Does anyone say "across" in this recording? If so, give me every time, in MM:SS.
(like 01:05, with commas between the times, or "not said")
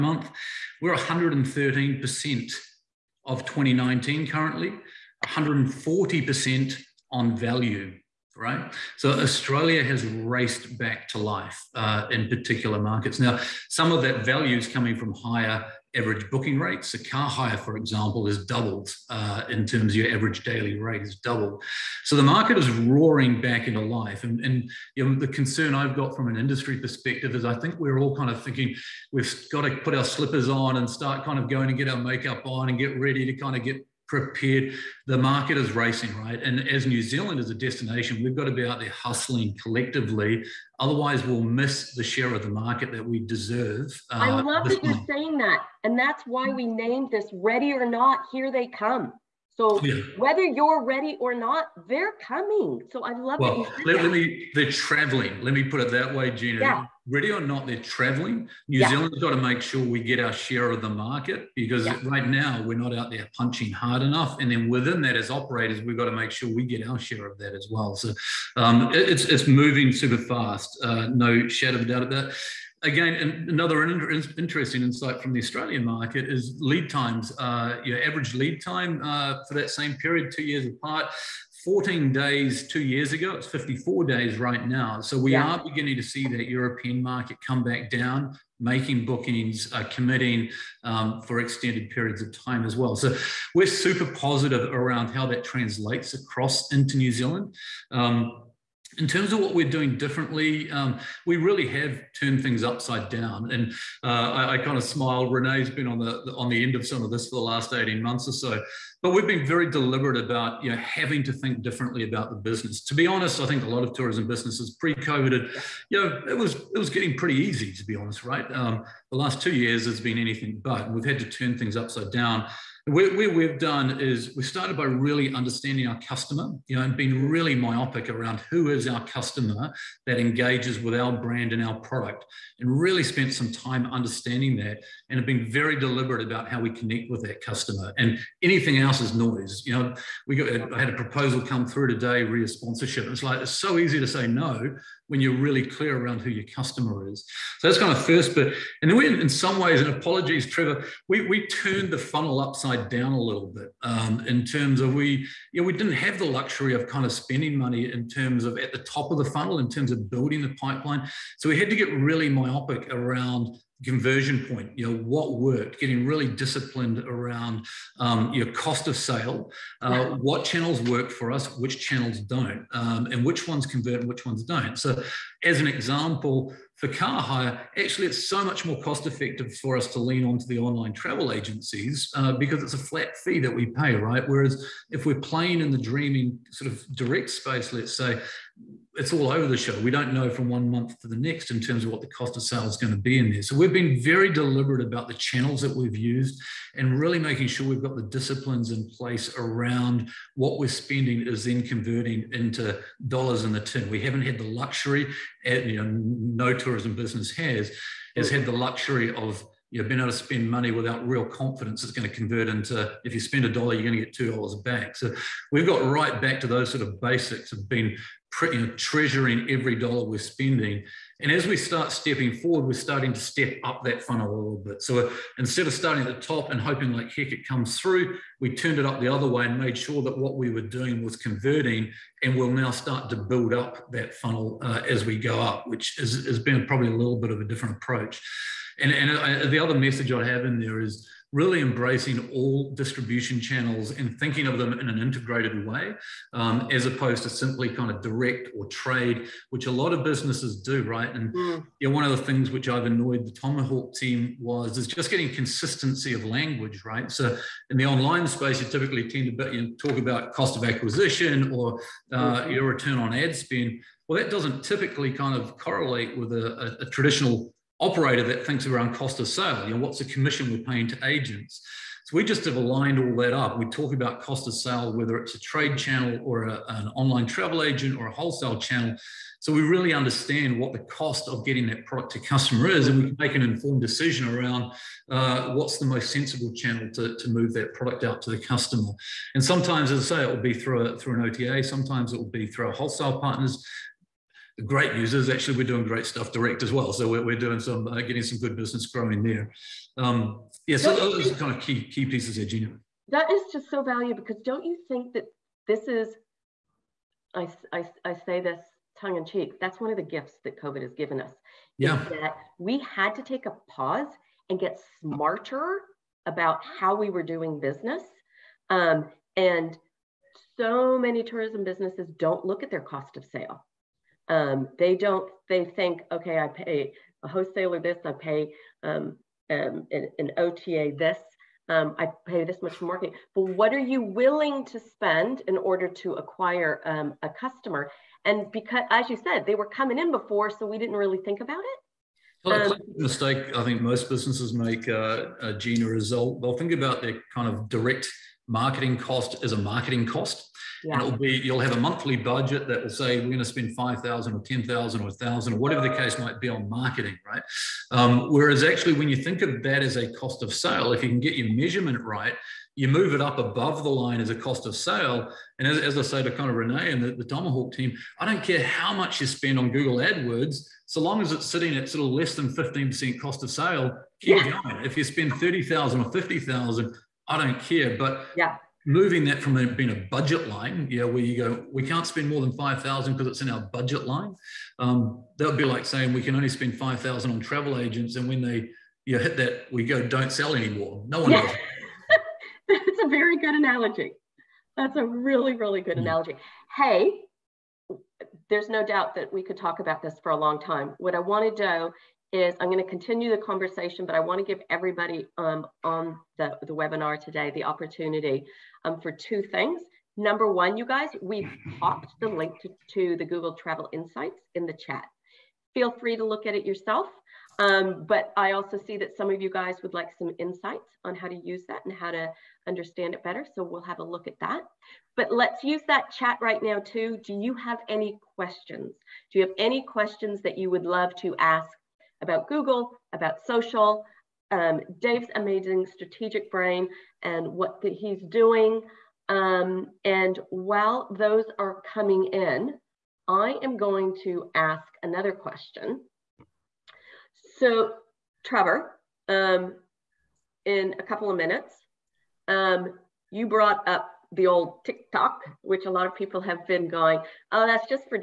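01:36.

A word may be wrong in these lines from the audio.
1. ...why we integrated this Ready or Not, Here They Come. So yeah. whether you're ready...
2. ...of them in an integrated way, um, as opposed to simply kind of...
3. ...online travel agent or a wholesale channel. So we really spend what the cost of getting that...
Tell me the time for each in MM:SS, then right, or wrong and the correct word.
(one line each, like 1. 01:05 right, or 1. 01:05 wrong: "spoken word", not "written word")
1. 00:46 wrong: "named", not "integrated"
2. 04:04 right
3. 04:36 wrong: "understand", not "spend".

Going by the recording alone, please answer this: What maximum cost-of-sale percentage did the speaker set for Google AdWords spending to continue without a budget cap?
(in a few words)
15%.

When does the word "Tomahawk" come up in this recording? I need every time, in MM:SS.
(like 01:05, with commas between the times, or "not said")
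04:13, 06:07.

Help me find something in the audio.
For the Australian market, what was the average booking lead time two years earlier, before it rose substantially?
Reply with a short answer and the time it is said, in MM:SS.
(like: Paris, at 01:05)
14 days, at 01:21.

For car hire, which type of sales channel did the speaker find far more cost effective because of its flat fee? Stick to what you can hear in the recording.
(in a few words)
Online travel agencies.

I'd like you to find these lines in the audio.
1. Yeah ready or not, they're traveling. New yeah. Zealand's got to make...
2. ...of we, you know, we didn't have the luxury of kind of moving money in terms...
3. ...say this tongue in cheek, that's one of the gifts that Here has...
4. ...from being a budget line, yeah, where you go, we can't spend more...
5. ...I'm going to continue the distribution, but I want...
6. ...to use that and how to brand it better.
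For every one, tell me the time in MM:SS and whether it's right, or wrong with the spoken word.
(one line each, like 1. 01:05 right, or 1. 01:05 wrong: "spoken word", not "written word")
1. 00:56 right
2. 02:34 wrong: "spending", not "moving"
3. 05:08 wrong: "COVID", not "Here"
4. 06:19 right
5. 06:42 wrong: "conversation", not "distribution"
6. 07:01 wrong: "understand", not "brand".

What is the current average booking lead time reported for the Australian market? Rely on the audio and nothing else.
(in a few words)
54 days.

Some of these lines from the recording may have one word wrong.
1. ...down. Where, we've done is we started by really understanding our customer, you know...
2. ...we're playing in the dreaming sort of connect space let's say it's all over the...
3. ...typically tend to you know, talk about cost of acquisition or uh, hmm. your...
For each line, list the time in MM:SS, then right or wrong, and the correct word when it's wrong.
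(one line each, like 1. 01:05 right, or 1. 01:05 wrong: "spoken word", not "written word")
1. 02:02 right
2. 03:05 wrong: "direct", not "connect"
3. 04:18 right.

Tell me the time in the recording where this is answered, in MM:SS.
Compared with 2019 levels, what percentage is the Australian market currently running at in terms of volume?
00:00.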